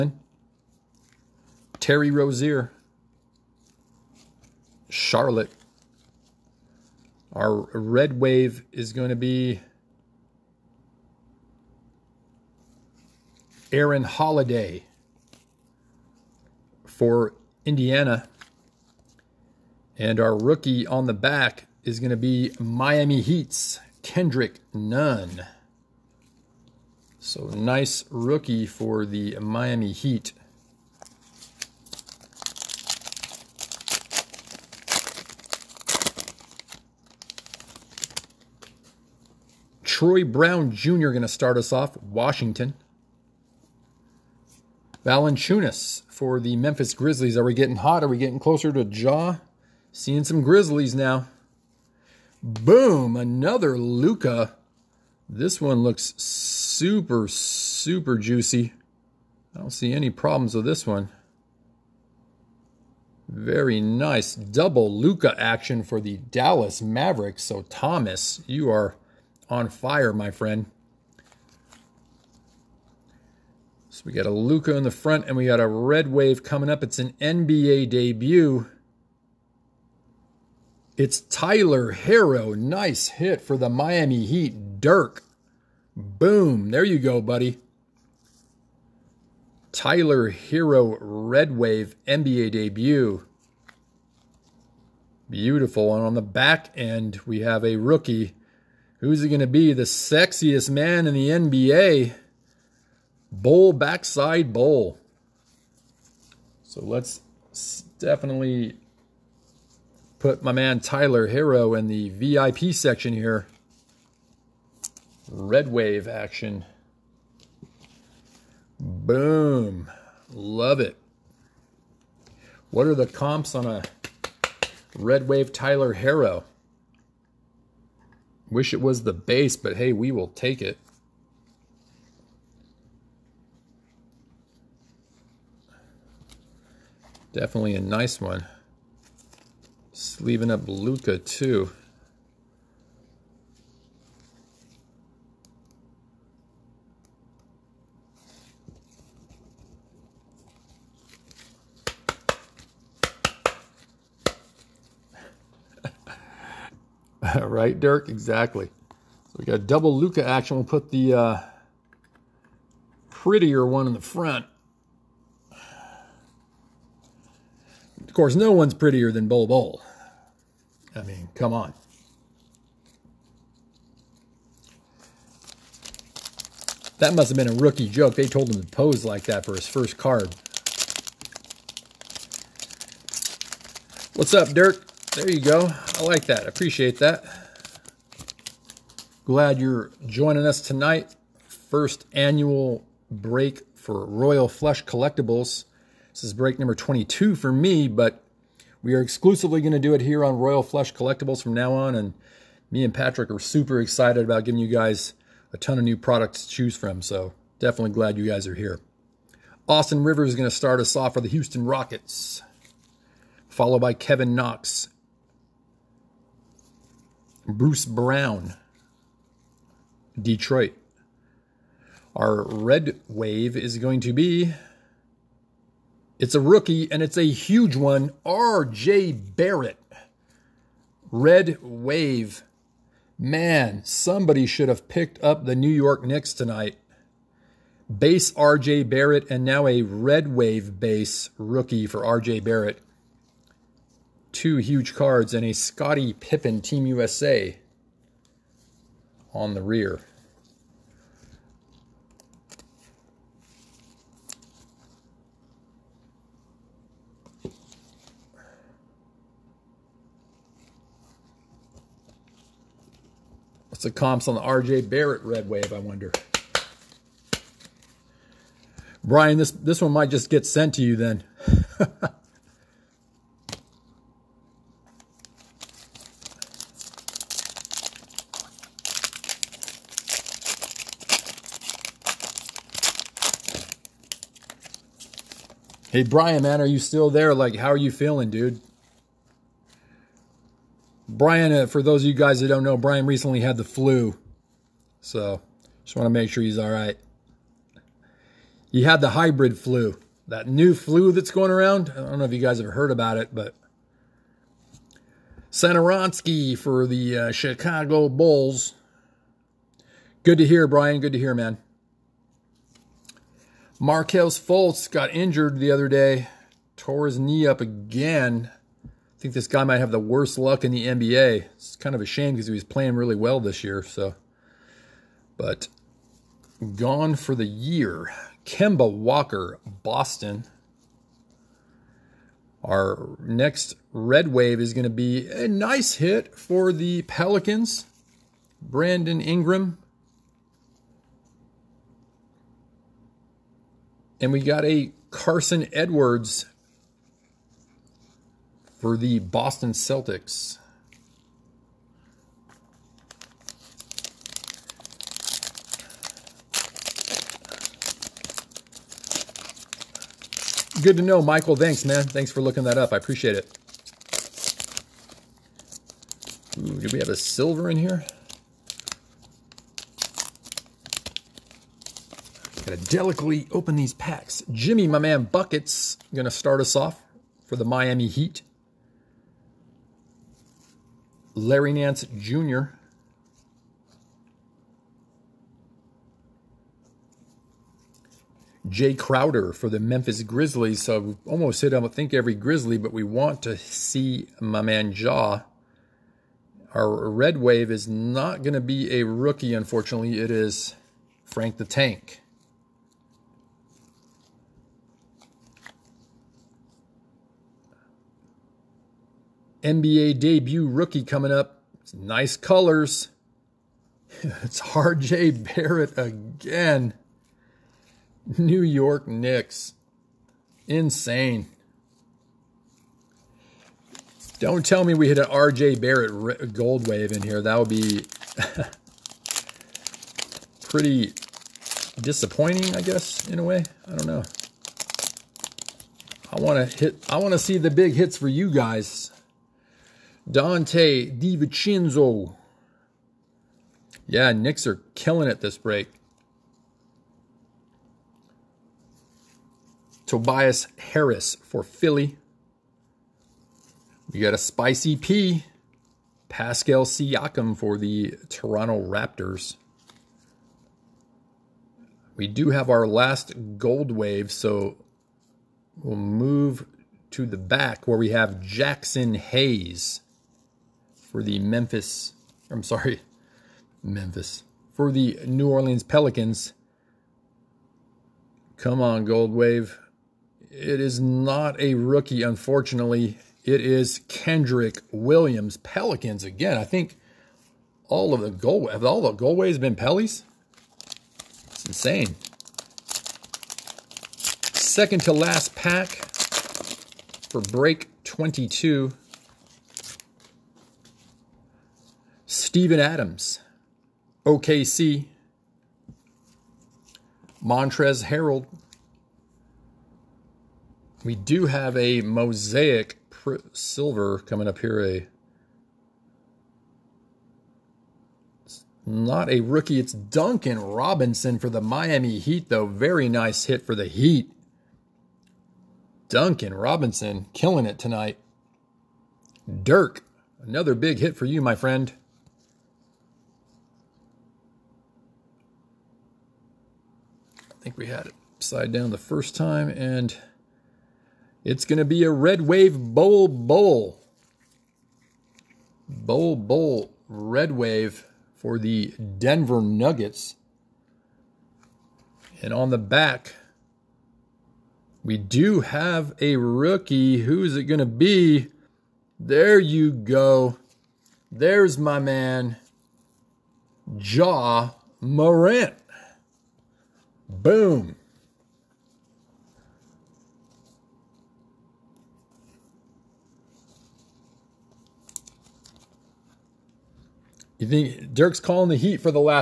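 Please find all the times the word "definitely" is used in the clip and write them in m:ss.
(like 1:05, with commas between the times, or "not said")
1:47, 2:17, 3:27.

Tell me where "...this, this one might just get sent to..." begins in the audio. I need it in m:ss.
4:29.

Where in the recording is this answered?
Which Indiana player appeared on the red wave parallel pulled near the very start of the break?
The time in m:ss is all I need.
0:13.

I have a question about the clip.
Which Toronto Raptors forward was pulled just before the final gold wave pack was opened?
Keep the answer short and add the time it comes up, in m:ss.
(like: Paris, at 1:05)
Pascal Siakam, at 7:36.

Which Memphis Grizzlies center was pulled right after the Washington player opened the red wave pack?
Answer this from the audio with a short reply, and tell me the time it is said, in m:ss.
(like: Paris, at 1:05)
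Valanciunas, at 0:45.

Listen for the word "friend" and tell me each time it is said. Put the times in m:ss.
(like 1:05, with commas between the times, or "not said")
1:10, 8:51.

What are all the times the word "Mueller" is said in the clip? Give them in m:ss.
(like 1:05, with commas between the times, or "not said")
not said.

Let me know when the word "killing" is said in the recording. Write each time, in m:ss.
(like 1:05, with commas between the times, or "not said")
7:24, 8:47.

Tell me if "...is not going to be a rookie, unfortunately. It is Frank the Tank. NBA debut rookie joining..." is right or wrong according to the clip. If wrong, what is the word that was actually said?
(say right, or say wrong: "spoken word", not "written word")
wrong: "coming", not "joining".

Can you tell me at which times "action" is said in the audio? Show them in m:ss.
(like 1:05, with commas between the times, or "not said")
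1:05, 1:56, 2:40.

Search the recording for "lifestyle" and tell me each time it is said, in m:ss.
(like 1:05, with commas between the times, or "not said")
not said.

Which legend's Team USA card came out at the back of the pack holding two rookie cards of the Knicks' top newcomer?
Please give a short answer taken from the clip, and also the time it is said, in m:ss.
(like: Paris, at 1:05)
Scottie Pippen, at 4:05.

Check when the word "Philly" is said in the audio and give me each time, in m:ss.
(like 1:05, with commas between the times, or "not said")
7:31.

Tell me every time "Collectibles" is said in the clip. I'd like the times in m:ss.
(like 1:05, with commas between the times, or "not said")
3:14, 3:20.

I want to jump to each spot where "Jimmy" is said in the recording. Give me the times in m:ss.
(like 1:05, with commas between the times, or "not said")
6:14.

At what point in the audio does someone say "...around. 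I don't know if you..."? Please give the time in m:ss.
5:01.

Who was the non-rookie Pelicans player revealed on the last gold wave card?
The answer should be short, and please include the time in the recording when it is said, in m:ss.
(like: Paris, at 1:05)
Kenrich Williams, at 8:04.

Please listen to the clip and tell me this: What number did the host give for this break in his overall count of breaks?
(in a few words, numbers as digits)
22.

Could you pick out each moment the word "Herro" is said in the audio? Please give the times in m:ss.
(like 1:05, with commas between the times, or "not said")
1:21, 1:30, 1:51, 2:05.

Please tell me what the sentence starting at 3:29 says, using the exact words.
Austin Rivers is going to start us off for the Houston Rockets, followed by Kevin Knox, Bruce Brown, Detroit.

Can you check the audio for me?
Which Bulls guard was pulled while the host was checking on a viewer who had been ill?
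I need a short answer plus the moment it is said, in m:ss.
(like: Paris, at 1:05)
Satoransky, at 5:05.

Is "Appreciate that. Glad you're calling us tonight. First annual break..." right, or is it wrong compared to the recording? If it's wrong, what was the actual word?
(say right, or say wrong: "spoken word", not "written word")
wrong: "joining", not "calling".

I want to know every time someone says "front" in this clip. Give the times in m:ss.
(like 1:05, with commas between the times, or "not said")
1:14, 2:44.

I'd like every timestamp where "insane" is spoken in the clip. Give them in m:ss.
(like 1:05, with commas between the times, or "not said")
7:00, 8:11.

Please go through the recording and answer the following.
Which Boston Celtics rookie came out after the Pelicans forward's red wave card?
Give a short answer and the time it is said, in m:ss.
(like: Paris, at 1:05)
Carson Edwards, at 5:45.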